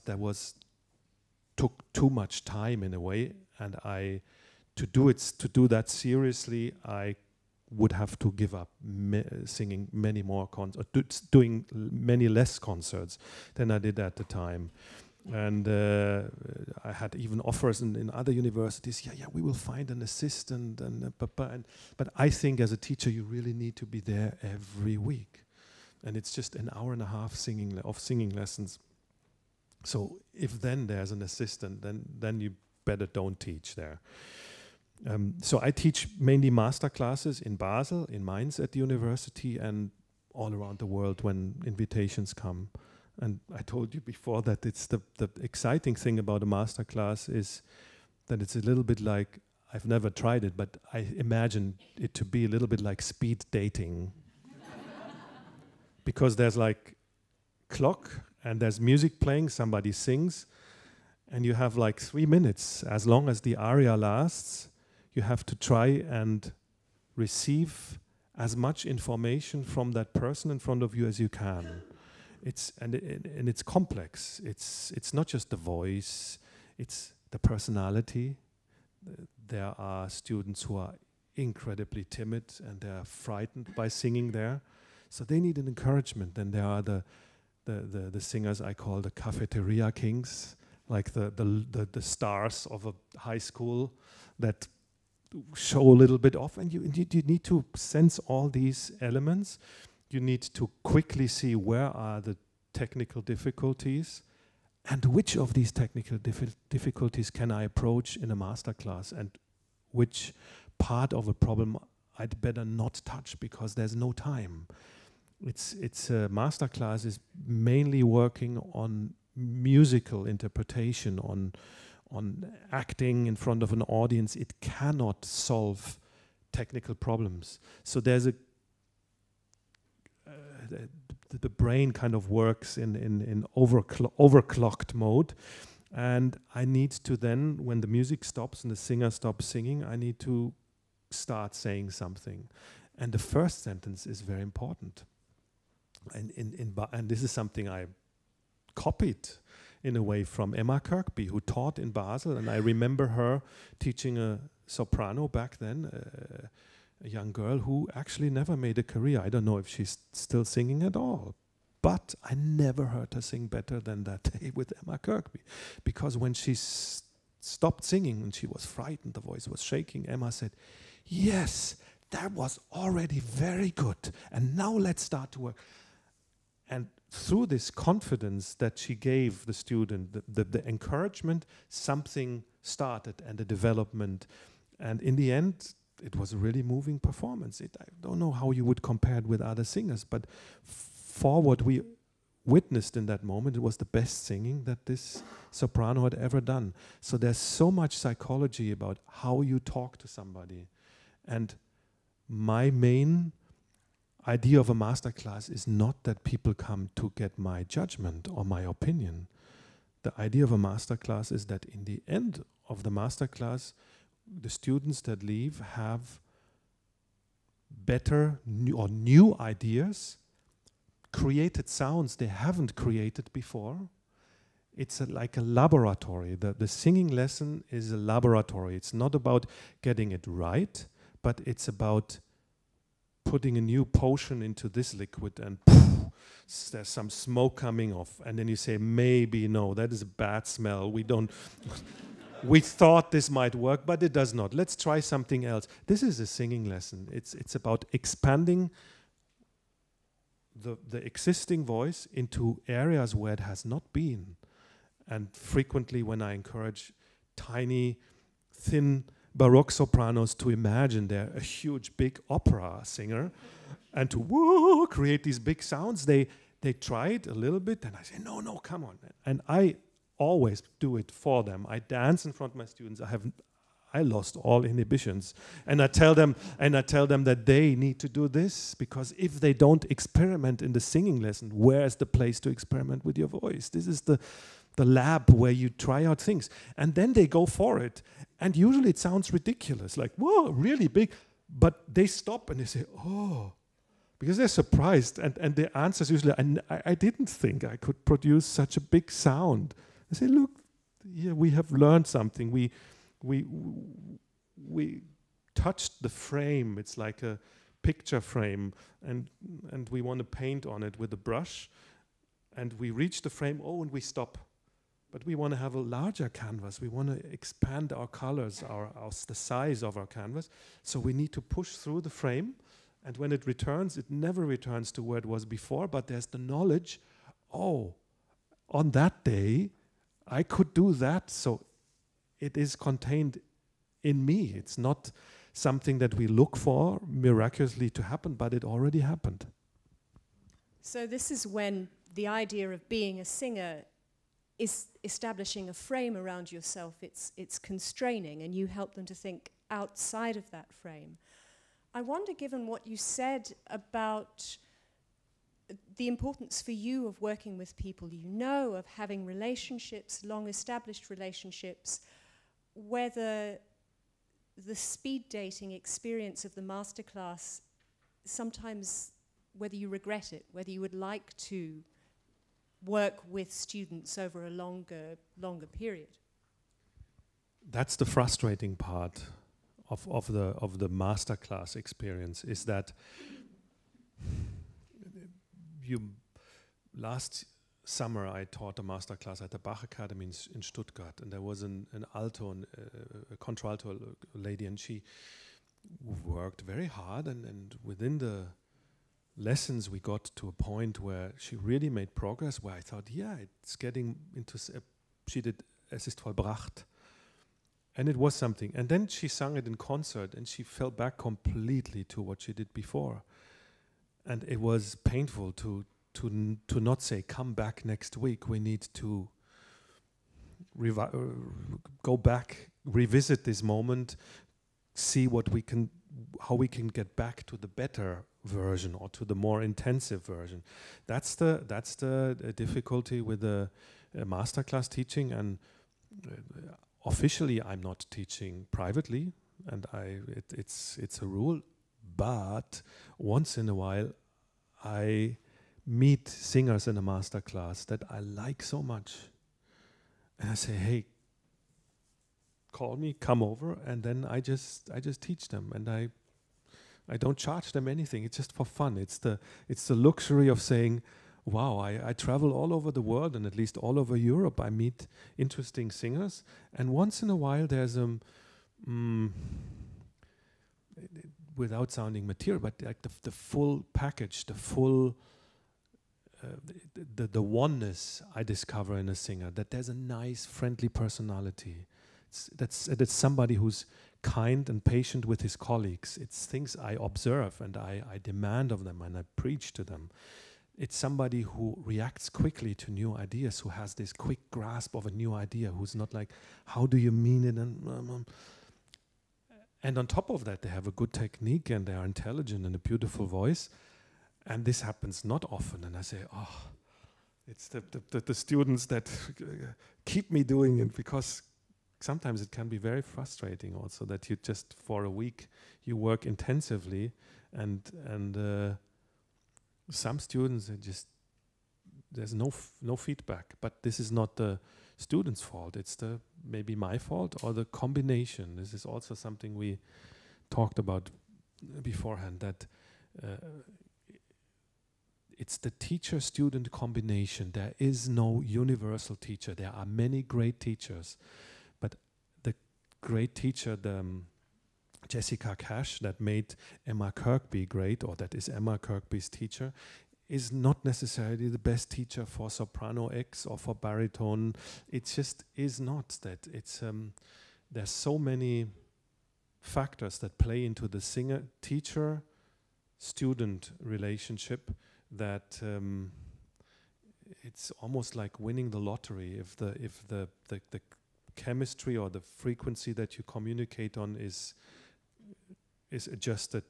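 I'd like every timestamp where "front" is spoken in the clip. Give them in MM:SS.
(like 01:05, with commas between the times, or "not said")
01:10, 02:03, 04:32.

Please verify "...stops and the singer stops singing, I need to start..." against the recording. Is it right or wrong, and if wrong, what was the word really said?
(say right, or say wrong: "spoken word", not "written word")
right.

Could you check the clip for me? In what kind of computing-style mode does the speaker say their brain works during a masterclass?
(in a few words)
Overclocked mode.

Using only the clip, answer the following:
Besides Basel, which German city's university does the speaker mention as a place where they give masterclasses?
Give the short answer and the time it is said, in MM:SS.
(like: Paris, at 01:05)
Mainz, at 00:38.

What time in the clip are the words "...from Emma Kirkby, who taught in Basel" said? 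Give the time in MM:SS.
02:30.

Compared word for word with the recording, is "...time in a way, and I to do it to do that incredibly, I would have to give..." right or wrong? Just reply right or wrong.
wrong.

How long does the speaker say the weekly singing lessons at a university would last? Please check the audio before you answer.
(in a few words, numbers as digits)
An hour and a half.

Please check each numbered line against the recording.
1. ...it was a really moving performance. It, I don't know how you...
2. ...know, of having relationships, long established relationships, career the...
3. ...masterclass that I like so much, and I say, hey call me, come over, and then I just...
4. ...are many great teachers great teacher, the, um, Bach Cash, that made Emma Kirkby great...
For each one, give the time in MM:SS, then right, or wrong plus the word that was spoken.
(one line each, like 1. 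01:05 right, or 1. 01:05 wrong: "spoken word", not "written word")
1. 03:06 right
2. 05:58 wrong: "whether", not "career"
3. 07:27 right
4. 08:59 wrong: "Jessica", not "Bach".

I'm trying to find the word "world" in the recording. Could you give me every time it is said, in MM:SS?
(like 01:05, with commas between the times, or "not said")
00:40, 07:43.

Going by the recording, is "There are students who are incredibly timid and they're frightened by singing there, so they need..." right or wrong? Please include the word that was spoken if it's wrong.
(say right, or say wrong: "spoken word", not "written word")
right.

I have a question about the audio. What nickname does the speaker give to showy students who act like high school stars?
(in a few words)
Cafeteria kings.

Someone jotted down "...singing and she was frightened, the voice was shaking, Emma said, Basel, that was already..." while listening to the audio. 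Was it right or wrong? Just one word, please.
wrong.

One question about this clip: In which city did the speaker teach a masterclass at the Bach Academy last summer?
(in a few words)
Stuttgart.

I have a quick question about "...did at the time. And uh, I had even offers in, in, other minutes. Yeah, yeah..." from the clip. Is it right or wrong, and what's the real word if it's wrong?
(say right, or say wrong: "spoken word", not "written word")
wrong: "universities", not "minutes".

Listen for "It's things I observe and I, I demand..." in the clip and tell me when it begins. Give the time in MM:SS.
08:06.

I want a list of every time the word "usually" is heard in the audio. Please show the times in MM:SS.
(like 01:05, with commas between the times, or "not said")
04:48, 04:56.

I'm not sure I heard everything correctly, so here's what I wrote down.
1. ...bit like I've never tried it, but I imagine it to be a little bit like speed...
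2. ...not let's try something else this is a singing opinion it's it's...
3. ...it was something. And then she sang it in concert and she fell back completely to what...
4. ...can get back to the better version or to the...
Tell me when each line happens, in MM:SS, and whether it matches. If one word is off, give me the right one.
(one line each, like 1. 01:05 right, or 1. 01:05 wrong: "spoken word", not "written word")
1. 00:48 right
2. 04:04 wrong: "lesson", not "opinion"
3. 06:48 right
4. 07:06 right.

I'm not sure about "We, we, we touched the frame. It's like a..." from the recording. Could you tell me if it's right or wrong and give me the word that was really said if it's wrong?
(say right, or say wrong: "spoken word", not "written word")
right.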